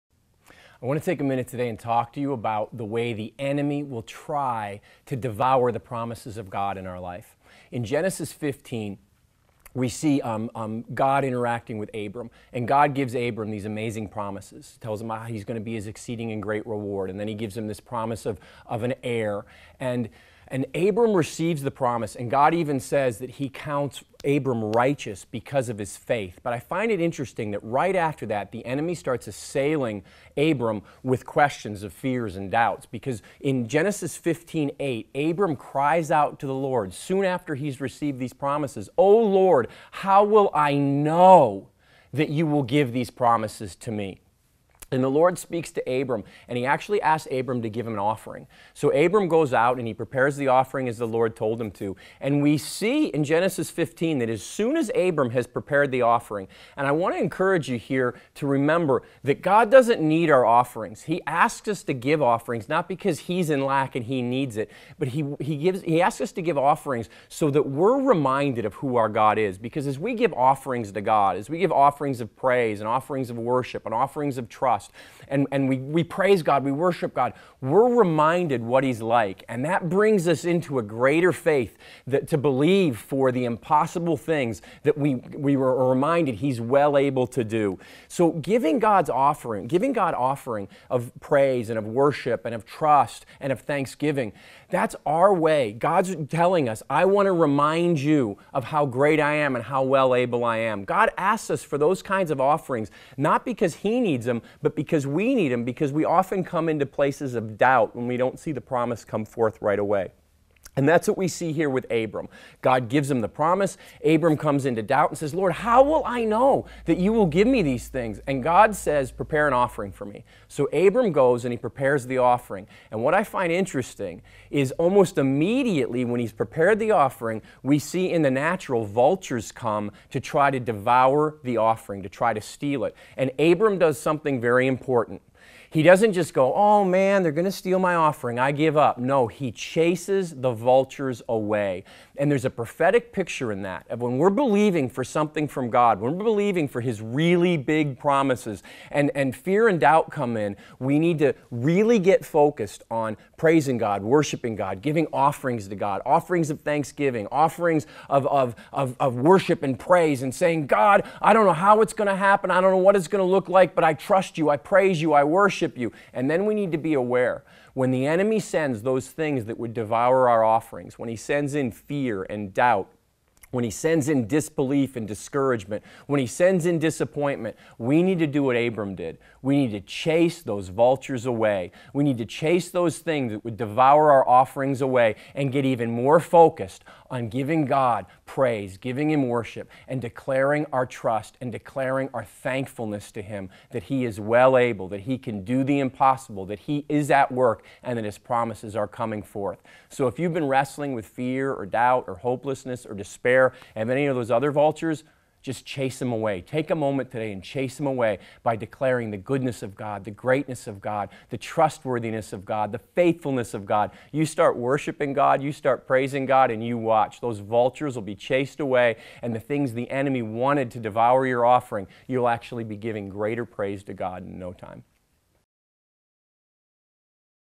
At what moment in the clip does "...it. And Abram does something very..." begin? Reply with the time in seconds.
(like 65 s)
132 s.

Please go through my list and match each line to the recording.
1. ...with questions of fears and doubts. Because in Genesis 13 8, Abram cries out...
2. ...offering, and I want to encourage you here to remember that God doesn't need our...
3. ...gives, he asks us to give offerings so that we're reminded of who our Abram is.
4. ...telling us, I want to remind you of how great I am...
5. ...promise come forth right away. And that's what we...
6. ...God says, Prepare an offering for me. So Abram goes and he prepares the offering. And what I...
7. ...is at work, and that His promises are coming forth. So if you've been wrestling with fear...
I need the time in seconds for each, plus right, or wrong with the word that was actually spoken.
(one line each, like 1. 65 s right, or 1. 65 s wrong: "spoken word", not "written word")
1. 31 s wrong: "15", not "13"
2. 56 s right
3. 65 s wrong: "God", not "Abram"
4. 96 s right
5. 108 s right
6. 118 s right
7. 196 s right.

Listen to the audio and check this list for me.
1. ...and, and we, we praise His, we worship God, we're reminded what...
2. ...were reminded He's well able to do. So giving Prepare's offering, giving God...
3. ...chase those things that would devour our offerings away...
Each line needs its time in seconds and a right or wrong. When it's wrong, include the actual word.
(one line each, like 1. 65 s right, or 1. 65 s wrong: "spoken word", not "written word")
1. 75 s wrong: "God", not "His"
2. 85 s wrong: "God", not "Prepare"
3. 182 s right.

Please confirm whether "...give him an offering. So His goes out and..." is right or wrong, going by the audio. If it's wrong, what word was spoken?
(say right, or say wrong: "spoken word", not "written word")
wrong: "Abram", not "His".